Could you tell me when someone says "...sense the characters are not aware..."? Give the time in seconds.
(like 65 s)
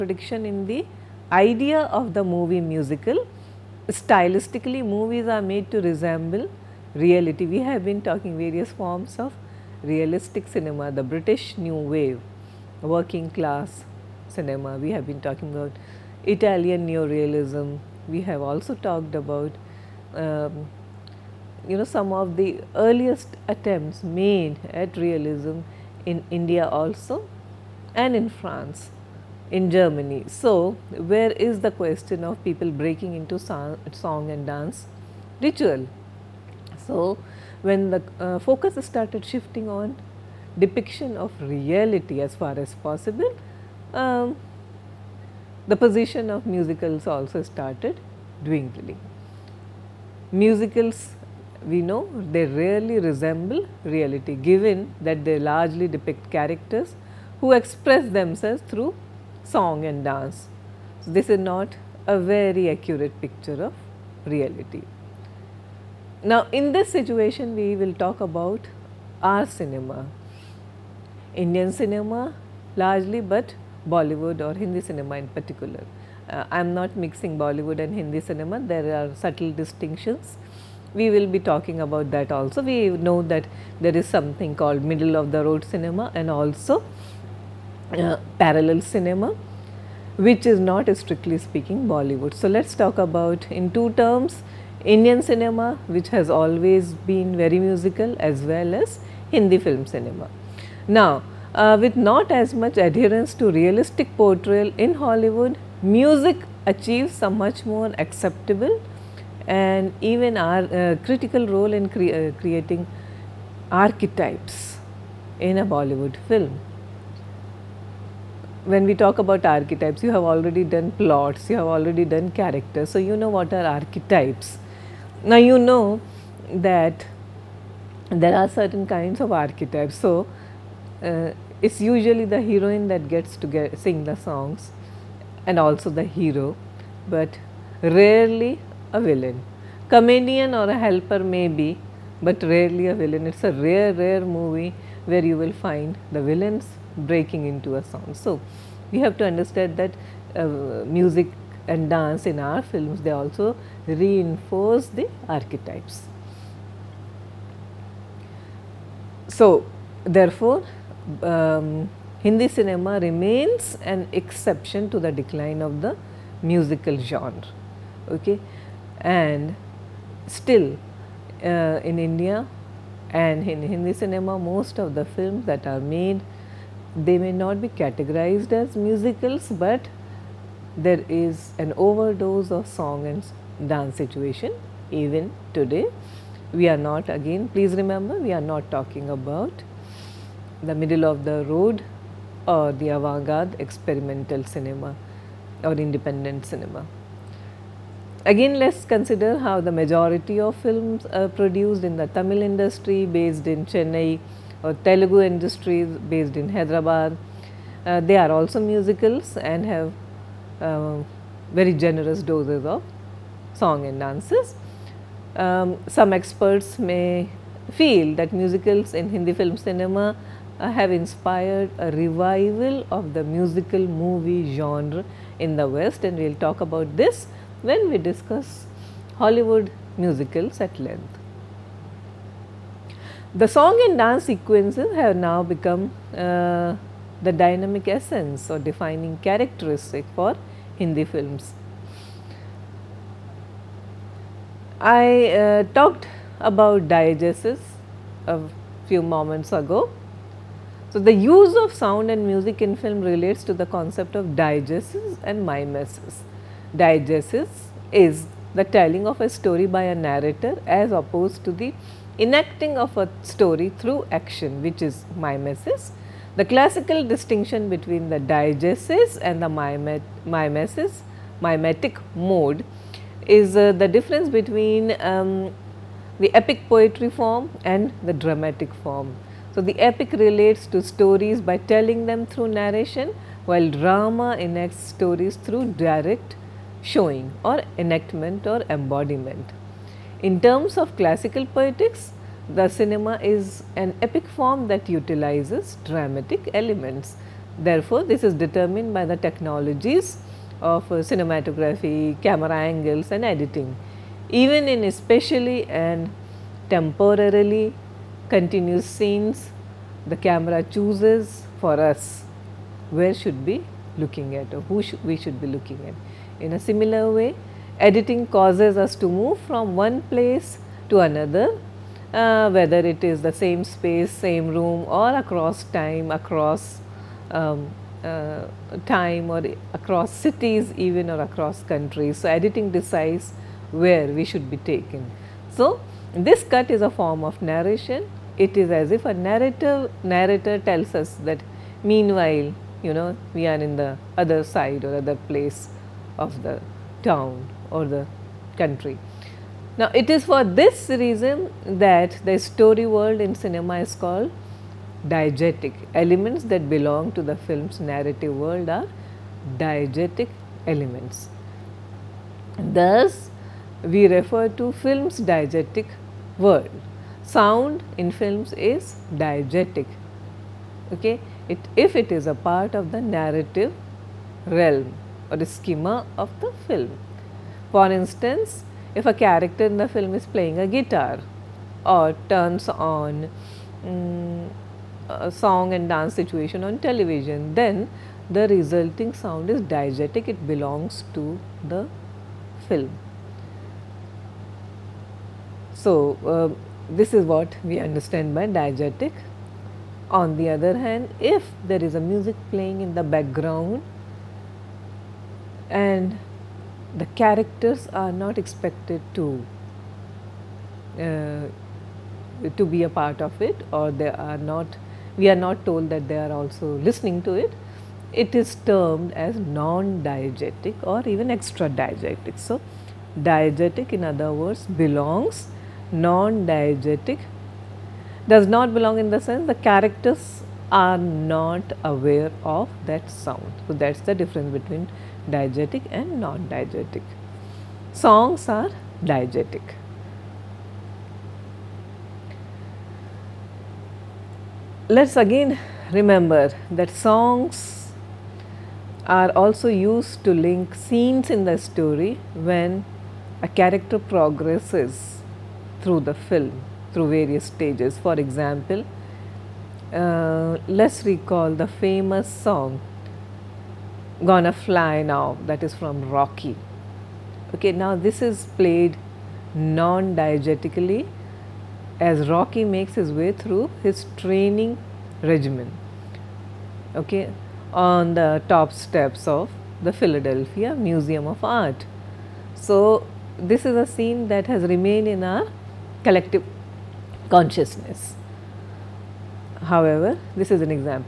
429 s.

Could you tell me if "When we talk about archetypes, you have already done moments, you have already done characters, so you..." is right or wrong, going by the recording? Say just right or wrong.
wrong.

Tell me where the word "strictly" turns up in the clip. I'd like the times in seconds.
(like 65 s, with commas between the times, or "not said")
90 s.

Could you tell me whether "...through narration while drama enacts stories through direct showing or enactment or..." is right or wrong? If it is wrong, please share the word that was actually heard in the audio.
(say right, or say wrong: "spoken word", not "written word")
right.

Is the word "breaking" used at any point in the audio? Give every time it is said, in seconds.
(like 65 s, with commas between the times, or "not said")
32 s, 146 s.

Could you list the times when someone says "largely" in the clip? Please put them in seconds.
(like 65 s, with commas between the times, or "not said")
55 s, 72 s.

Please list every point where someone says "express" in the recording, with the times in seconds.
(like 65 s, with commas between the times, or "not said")
57 s.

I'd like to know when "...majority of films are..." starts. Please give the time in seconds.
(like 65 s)
199 s.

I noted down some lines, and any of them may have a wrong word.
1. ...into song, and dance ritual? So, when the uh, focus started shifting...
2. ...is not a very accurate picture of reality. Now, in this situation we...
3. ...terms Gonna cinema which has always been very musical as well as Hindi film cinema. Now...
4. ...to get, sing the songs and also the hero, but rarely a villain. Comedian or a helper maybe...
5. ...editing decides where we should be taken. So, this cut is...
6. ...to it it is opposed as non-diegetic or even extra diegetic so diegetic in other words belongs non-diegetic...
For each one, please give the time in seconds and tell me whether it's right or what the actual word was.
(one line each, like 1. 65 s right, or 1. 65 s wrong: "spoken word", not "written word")
1. 33 s right
2. 61 s right
3. 93 s wrong: "Indian", not "Gonna"
4. 133 s right
5. 332 s right
6. 417 s wrong: "termed", not "opposed".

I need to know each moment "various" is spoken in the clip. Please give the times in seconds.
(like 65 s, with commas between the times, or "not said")
8 s, 457 s.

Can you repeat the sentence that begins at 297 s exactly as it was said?
Therefore, this is determined by the technologies of uh, cinematography, camera angles and editing.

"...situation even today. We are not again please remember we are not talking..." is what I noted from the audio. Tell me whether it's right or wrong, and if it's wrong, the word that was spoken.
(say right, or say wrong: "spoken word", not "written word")
right.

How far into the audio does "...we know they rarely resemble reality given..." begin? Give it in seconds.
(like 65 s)
51 s.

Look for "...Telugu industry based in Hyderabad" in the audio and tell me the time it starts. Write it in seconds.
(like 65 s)
204 s.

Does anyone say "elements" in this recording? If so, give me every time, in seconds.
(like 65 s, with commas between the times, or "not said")
296 s, 355 s, 360 s.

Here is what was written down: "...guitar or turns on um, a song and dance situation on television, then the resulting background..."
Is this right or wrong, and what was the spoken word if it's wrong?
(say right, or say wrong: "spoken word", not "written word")
wrong: "sound", not "background".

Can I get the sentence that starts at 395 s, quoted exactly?
So, uh, this is what we understand by diegetic.